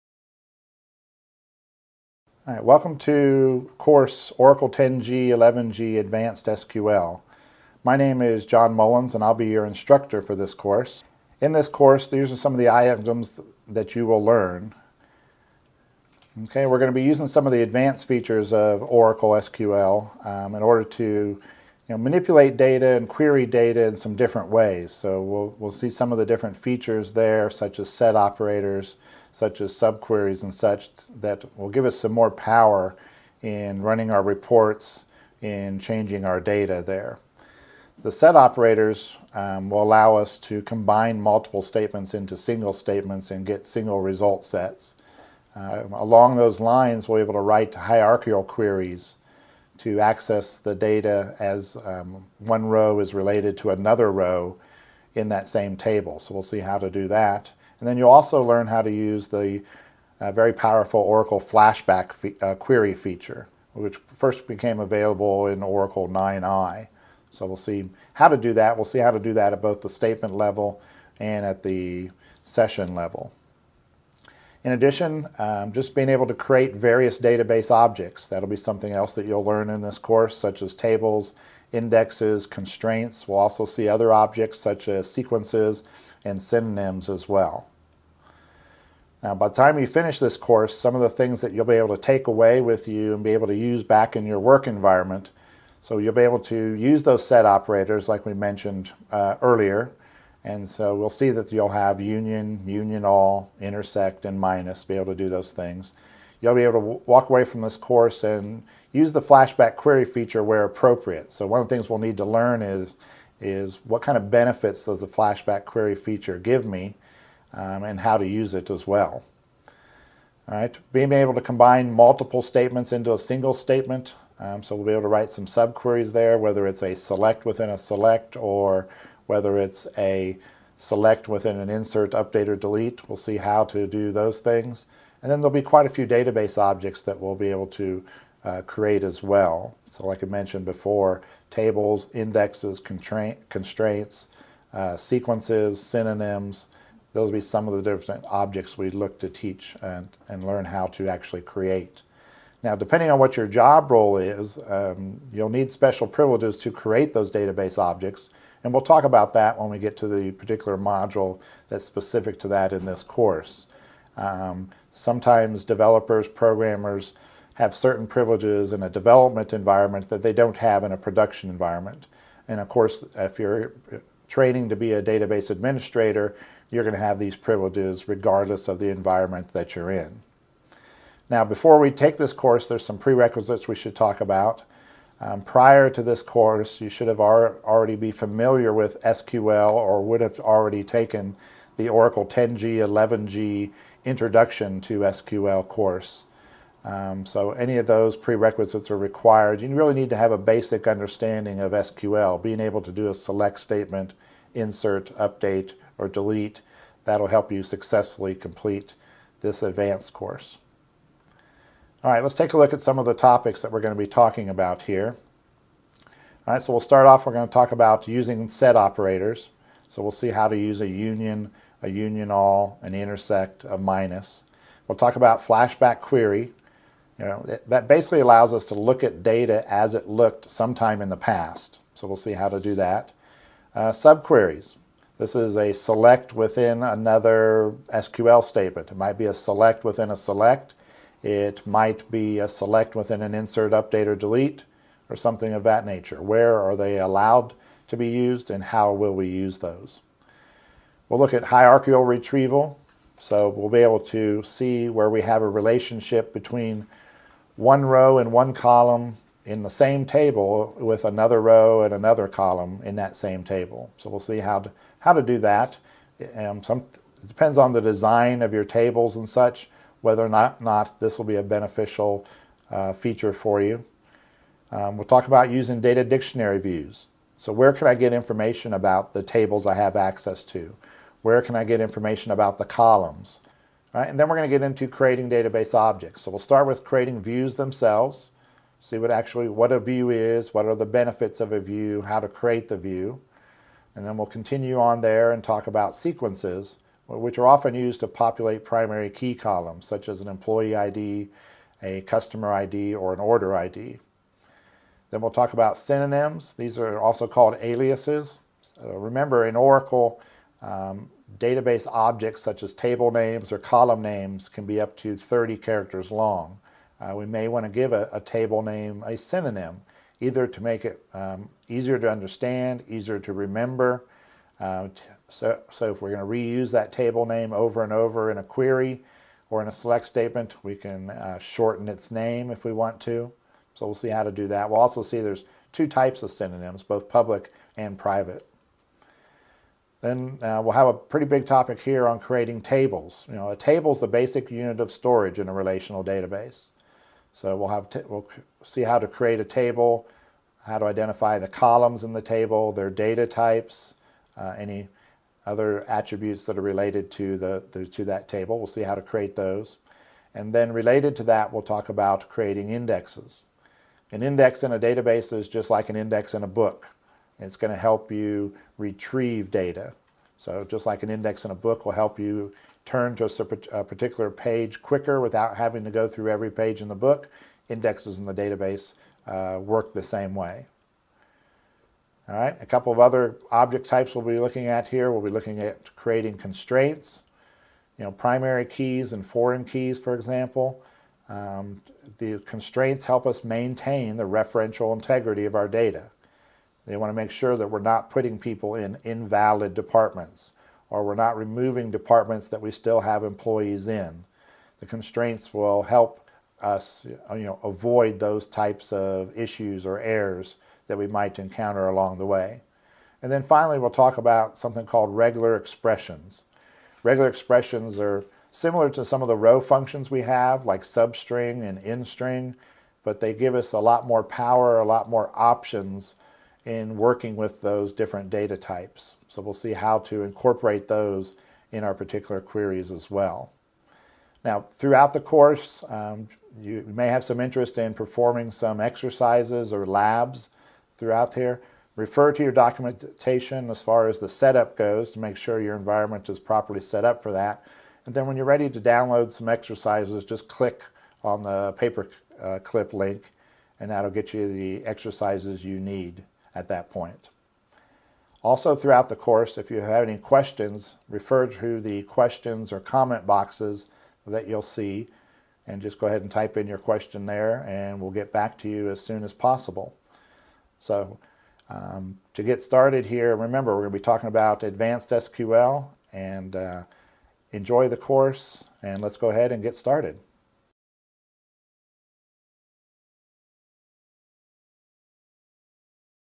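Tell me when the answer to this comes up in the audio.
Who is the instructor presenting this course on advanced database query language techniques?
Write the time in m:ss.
0:08.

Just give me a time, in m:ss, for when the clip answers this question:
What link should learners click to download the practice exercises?
7:31.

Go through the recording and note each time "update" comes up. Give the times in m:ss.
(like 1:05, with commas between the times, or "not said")
2:12, 3:25, 4:03.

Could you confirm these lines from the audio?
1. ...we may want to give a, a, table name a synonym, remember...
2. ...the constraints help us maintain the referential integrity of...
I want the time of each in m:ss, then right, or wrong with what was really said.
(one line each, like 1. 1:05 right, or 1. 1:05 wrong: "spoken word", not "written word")
1. 5:17 wrong: "either", not "remember"
2. 6:32 right.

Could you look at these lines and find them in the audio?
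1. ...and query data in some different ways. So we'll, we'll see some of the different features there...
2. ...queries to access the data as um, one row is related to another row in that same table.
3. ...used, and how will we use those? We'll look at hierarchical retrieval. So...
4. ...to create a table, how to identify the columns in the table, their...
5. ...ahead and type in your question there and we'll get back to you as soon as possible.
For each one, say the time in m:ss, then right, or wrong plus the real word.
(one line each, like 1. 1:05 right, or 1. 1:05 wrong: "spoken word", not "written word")
1. 0:22 right
2. 0:48 right
3. 4:08 right
4. 5:48 right
5. 7:46 right.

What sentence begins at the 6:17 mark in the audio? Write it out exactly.
Indexes in the database uh, work the same way.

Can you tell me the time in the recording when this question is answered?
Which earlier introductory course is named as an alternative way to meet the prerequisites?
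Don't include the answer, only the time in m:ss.
3:11.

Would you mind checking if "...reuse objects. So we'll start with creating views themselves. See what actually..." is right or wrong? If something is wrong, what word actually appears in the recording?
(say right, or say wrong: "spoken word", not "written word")
wrong: "database", not "reuse".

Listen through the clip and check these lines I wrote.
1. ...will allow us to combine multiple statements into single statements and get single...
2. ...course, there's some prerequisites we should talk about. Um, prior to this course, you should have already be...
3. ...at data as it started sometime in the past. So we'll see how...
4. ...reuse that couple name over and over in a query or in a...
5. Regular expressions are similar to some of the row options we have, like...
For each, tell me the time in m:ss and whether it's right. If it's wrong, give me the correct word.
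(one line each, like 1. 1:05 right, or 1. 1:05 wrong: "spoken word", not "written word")
1. 0:39 right
2. 3:02 right
3. 3:49 wrong: "looked", not "started"
4. 5:26 wrong: "table", not "couple"
5. 6:57 wrong: "functions", not "options".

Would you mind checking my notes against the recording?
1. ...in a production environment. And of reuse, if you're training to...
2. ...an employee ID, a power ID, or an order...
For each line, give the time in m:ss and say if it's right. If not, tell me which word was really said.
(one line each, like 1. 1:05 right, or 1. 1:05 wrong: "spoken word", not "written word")
1. 2:50 wrong: "course", not "reuse"
2. 5:00 wrong: "customer", not "power".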